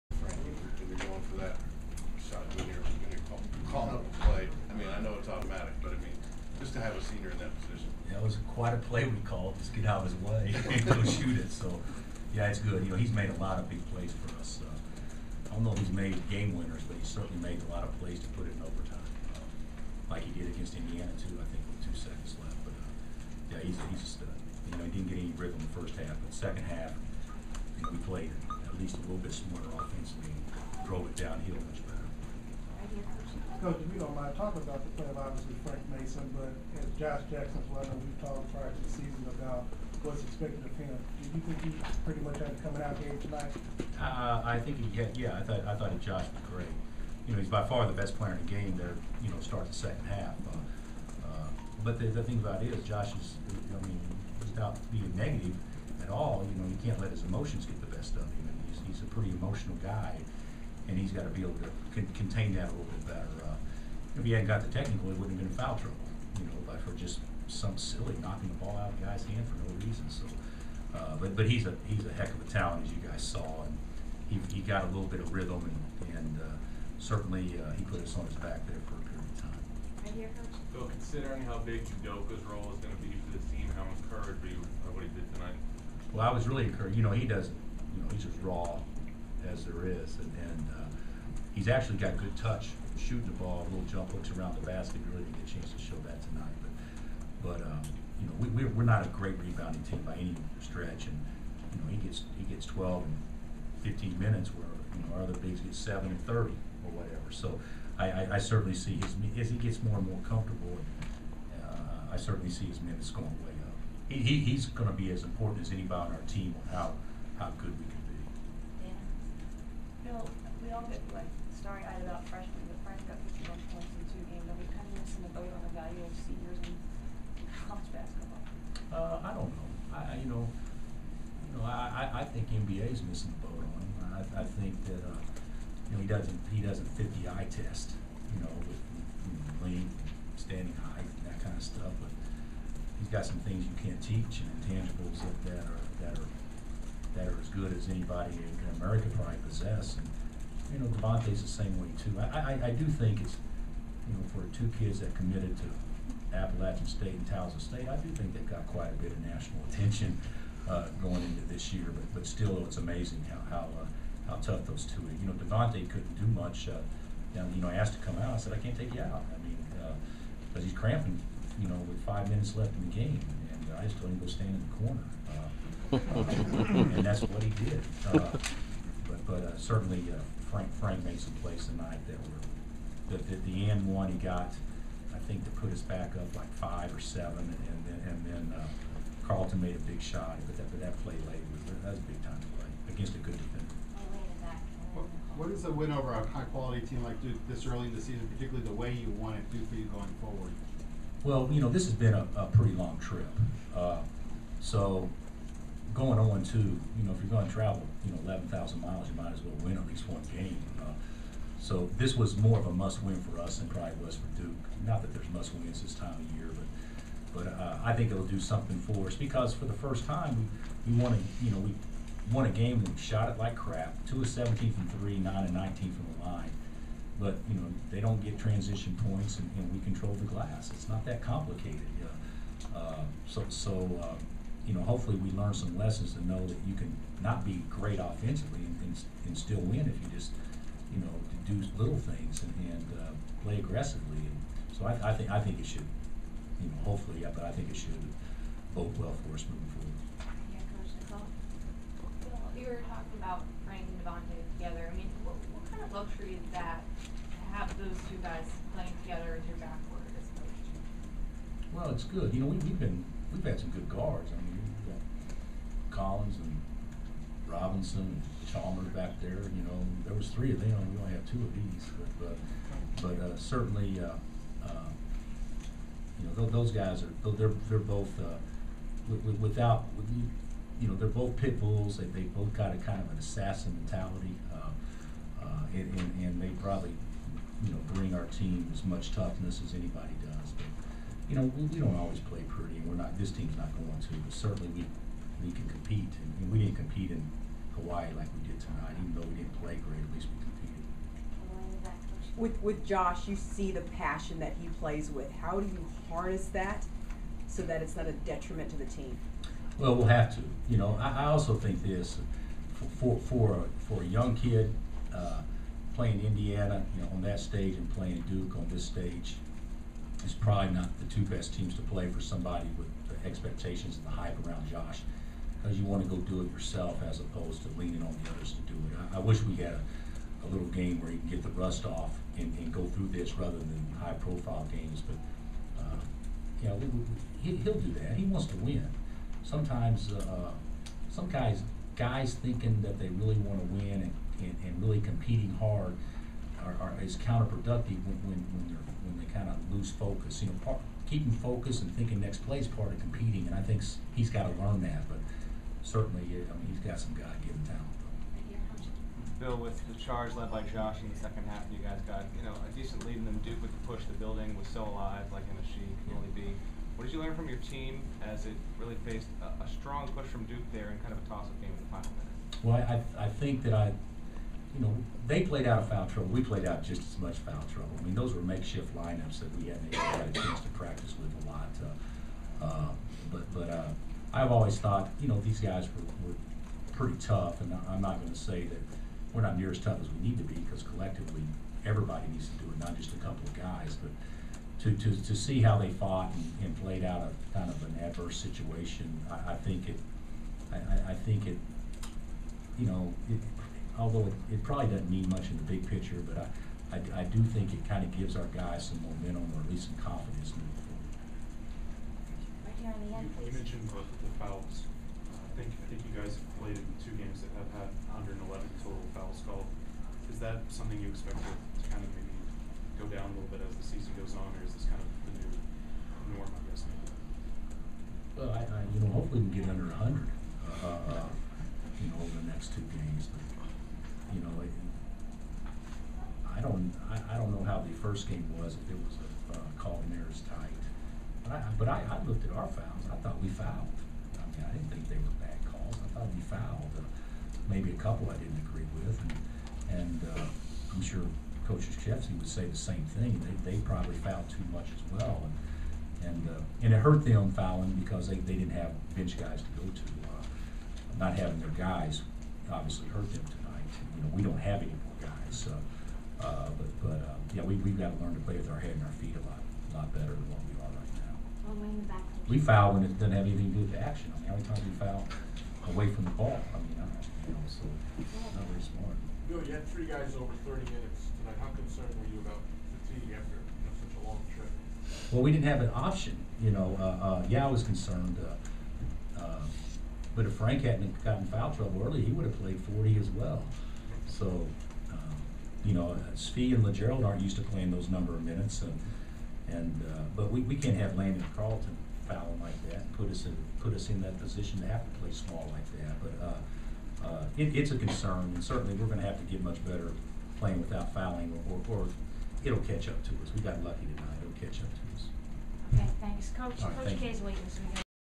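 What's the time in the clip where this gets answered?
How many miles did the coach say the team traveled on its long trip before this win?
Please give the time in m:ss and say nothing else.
3:28.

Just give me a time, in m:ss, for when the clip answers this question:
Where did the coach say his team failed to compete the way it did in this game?
4:57.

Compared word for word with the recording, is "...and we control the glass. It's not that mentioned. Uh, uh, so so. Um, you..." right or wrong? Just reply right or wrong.
wrong.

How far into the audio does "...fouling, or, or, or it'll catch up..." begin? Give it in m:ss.
8:31.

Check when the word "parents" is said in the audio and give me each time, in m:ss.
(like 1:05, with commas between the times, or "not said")
not said.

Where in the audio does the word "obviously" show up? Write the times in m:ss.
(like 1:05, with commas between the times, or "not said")
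0:35, 7:42.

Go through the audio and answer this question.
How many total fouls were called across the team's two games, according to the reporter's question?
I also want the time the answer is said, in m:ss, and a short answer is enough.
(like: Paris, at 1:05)
111, at 6:58.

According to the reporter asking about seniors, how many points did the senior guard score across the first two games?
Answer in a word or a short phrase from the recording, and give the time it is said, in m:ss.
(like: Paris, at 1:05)
51, at 2:03.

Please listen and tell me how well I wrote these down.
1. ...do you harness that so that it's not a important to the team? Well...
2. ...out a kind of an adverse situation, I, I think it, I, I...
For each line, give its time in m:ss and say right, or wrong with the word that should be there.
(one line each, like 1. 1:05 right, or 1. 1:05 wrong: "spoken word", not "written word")
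1. 5:05 wrong: "detriment", not "important"
2. 6:37 right.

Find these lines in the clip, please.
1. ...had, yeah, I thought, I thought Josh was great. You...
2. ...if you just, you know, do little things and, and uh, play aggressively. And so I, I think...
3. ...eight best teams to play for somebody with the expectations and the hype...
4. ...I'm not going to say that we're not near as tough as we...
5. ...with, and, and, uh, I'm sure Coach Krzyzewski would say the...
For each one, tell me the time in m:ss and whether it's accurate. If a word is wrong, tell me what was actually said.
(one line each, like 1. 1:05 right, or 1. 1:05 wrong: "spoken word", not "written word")
1. 0:44 right
2. 3:59 right
3. 5:21 wrong: "two", not "eight"
4. 6:27 right
5. 7:29 right.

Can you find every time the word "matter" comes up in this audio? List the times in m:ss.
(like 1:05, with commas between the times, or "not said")
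not said.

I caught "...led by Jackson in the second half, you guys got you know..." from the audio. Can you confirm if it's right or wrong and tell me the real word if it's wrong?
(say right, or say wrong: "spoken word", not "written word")
wrong: "Josh", not "Jackson".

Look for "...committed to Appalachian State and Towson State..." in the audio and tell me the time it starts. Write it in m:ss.
2:35.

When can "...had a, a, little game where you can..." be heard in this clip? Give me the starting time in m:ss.
5:29.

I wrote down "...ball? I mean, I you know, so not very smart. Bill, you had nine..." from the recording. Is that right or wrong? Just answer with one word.
wrong.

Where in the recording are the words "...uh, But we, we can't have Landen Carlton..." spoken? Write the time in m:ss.
8:20.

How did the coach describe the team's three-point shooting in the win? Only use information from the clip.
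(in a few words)
2 of 17.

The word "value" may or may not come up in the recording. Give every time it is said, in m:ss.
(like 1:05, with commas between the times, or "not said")
2:05.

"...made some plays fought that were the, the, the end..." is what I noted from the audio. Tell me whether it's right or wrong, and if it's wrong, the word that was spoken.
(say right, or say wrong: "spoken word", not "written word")
wrong: "tonight", not "fought".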